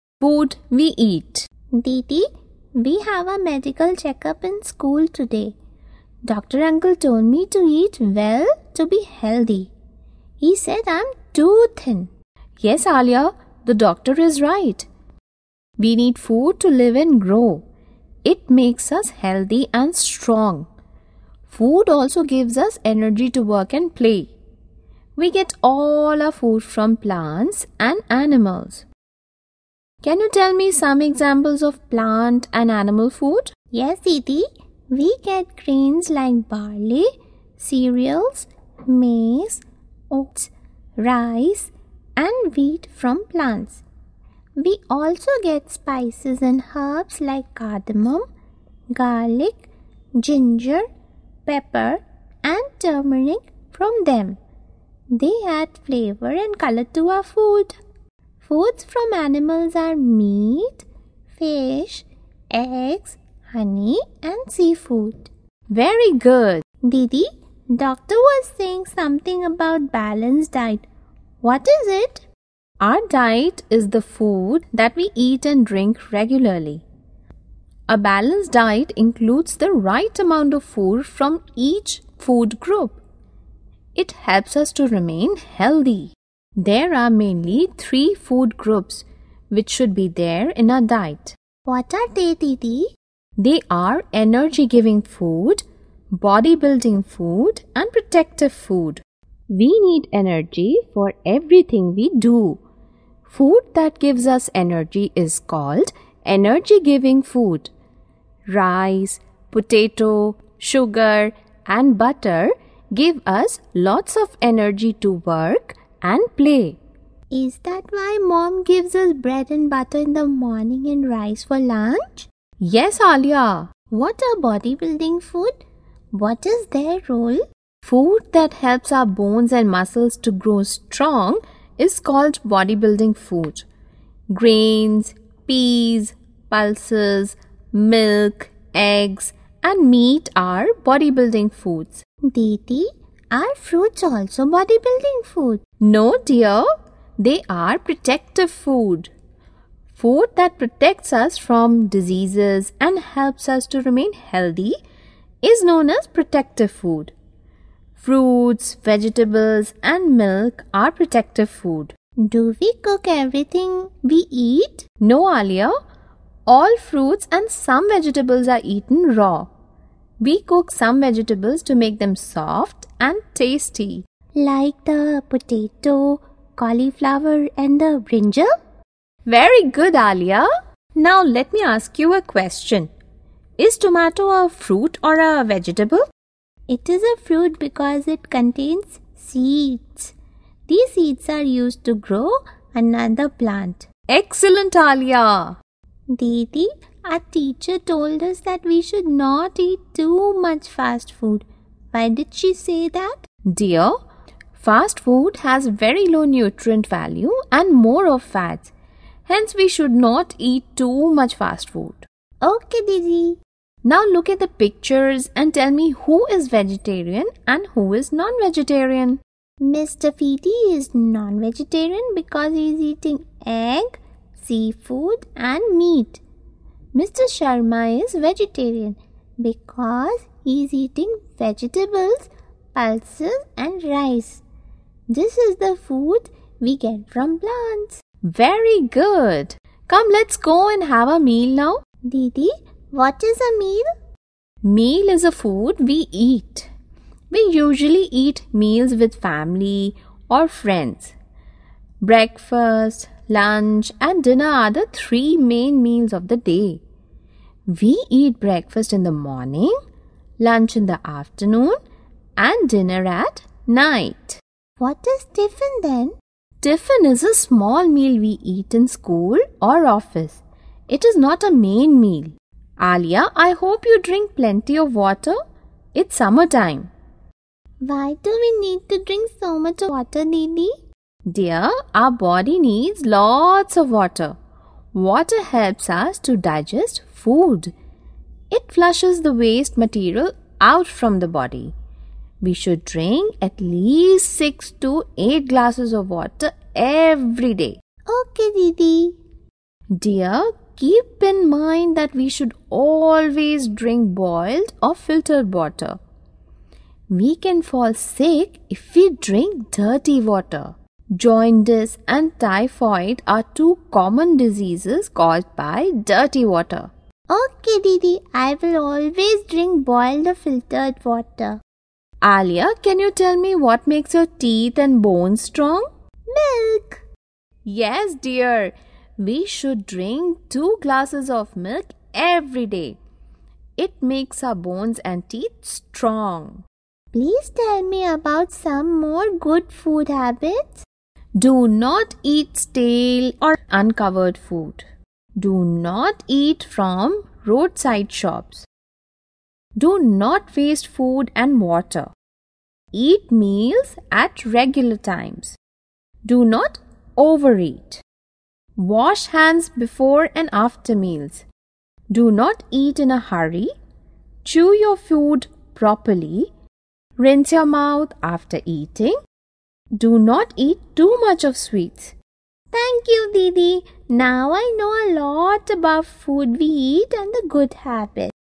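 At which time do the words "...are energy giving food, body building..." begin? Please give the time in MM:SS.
01:33.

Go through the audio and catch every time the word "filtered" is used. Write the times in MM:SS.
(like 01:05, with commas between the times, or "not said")
05:04, 05:20.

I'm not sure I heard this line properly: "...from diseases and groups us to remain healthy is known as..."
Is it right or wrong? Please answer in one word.
wrong.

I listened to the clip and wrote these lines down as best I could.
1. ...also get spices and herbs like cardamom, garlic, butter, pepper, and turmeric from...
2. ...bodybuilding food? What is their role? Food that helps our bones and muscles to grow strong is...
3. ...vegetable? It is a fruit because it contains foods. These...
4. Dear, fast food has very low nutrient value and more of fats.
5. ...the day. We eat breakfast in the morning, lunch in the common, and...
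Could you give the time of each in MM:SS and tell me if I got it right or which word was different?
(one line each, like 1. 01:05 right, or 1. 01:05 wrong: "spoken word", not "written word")
1. 00:44 wrong: "ginger", not "butter"
2. 02:04 right
3. 03:05 wrong: "seeds", not "foods"
4. 03:23 right
5. 04:16 wrong: "afternoon", not "common".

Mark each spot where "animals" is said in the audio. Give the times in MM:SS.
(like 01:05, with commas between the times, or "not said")
00:28, 00:32, 00:59.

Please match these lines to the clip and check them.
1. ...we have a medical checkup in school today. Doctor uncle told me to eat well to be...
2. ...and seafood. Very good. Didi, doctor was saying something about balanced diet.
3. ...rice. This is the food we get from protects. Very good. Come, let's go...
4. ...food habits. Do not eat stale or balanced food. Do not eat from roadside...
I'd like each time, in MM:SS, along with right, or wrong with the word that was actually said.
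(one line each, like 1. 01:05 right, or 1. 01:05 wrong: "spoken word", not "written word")
1. 00:02 right
2. 01:04 right
3. 03:53 wrong: "plants", not "protects"
4. 05:39 wrong: "uncovered", not "balanced".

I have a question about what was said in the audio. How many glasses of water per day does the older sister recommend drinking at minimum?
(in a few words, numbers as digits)
6 to 8.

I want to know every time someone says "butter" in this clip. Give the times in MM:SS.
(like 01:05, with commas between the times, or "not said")
01:51, 01:59.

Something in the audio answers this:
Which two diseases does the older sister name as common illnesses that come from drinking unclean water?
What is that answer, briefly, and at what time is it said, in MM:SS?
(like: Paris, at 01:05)
Jaundice and typhoid, at 05:11.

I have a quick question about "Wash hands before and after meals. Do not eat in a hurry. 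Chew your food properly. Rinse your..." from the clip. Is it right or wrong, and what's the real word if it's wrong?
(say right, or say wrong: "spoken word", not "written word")
right.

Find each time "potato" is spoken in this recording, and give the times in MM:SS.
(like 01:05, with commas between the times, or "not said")
01:49, 02:55.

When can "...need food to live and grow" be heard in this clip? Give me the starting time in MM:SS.
00:15.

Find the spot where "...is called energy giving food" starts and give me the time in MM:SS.
01:45.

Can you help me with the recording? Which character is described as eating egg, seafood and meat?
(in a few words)
Mr. Feety.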